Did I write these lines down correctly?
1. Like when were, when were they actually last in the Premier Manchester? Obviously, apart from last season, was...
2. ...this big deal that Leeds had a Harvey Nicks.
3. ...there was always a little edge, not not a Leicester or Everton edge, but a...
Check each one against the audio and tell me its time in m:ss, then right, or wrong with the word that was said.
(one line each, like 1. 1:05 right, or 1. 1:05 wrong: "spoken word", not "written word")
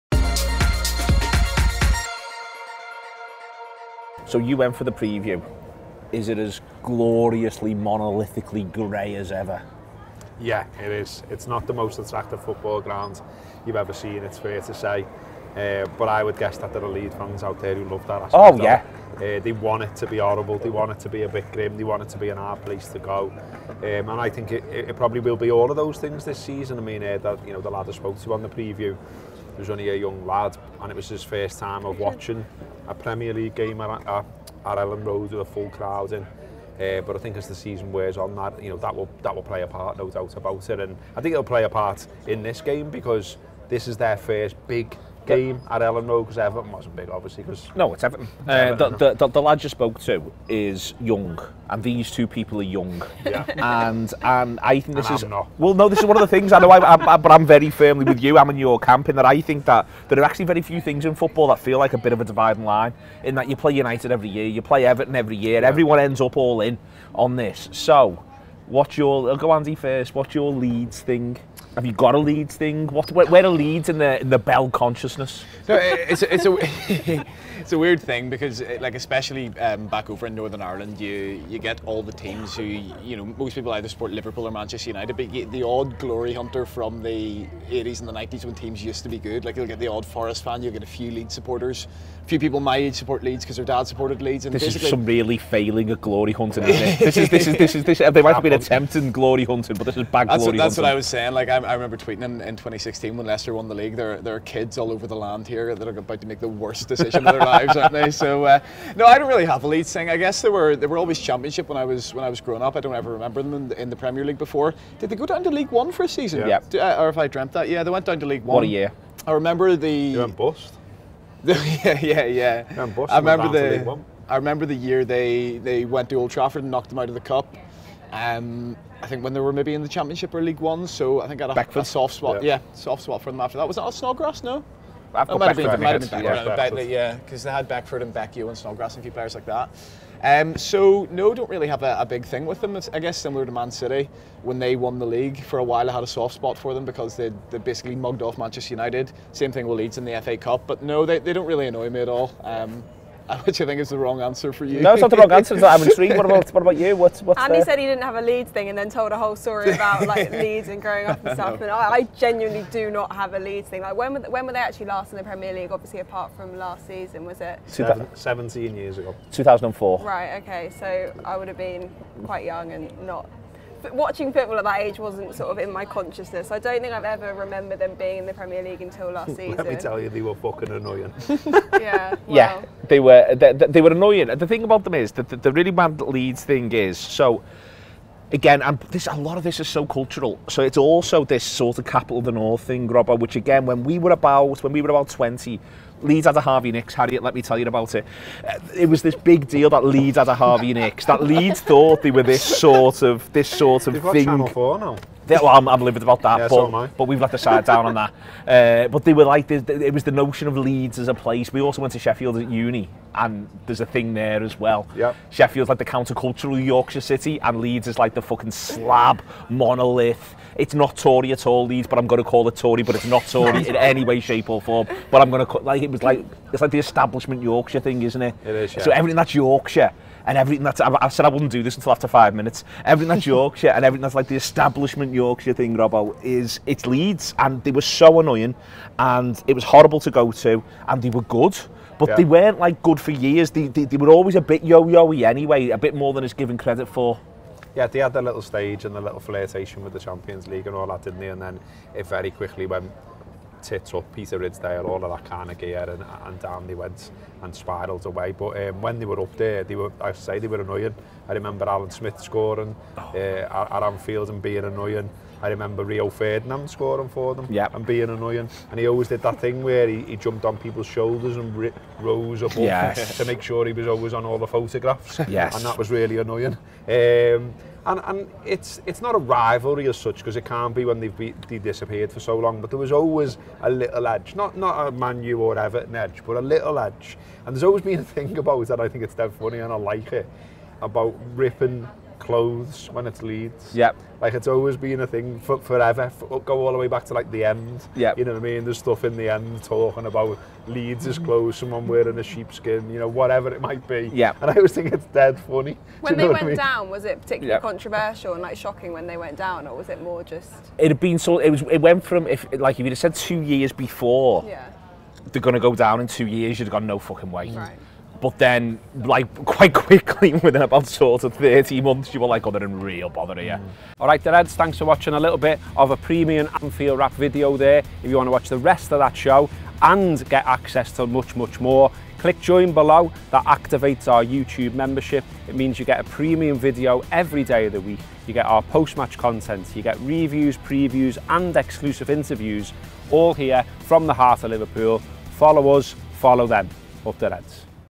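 1. 2:43 wrong: "League", not "Manchester"
2. 3:19 right
3. 4:42 wrong: "Manu", not "Leicester".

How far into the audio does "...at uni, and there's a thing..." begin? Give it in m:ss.
3:32.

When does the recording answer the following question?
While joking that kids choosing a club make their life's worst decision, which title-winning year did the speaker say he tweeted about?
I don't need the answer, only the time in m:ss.
1:42.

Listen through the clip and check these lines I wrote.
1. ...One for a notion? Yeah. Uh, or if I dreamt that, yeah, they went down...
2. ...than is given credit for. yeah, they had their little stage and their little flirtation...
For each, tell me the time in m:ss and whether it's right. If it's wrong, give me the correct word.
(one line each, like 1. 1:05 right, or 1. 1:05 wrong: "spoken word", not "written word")
1. 1:55 wrong: "season", not "notion"
2. 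4:06 right.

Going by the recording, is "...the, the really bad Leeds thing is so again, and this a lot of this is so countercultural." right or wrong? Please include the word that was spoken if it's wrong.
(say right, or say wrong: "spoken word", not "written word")
wrong: "cultural", not "countercultural".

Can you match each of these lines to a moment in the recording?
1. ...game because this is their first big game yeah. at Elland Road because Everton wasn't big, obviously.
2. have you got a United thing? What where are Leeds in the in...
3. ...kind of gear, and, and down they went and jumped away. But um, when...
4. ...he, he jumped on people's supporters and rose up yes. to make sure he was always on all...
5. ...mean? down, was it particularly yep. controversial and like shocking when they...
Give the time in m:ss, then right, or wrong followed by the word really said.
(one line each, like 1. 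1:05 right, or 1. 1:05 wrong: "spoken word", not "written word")
1. 0:42 right
2. 1:11 wrong: "Leeds", not "United"
3. 4:15 wrong: "spiralled", not "jumped"
4. 4:29 wrong: "shoulders", not "supporters"
5. 5:06 right.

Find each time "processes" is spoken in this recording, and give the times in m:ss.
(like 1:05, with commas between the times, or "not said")
not said.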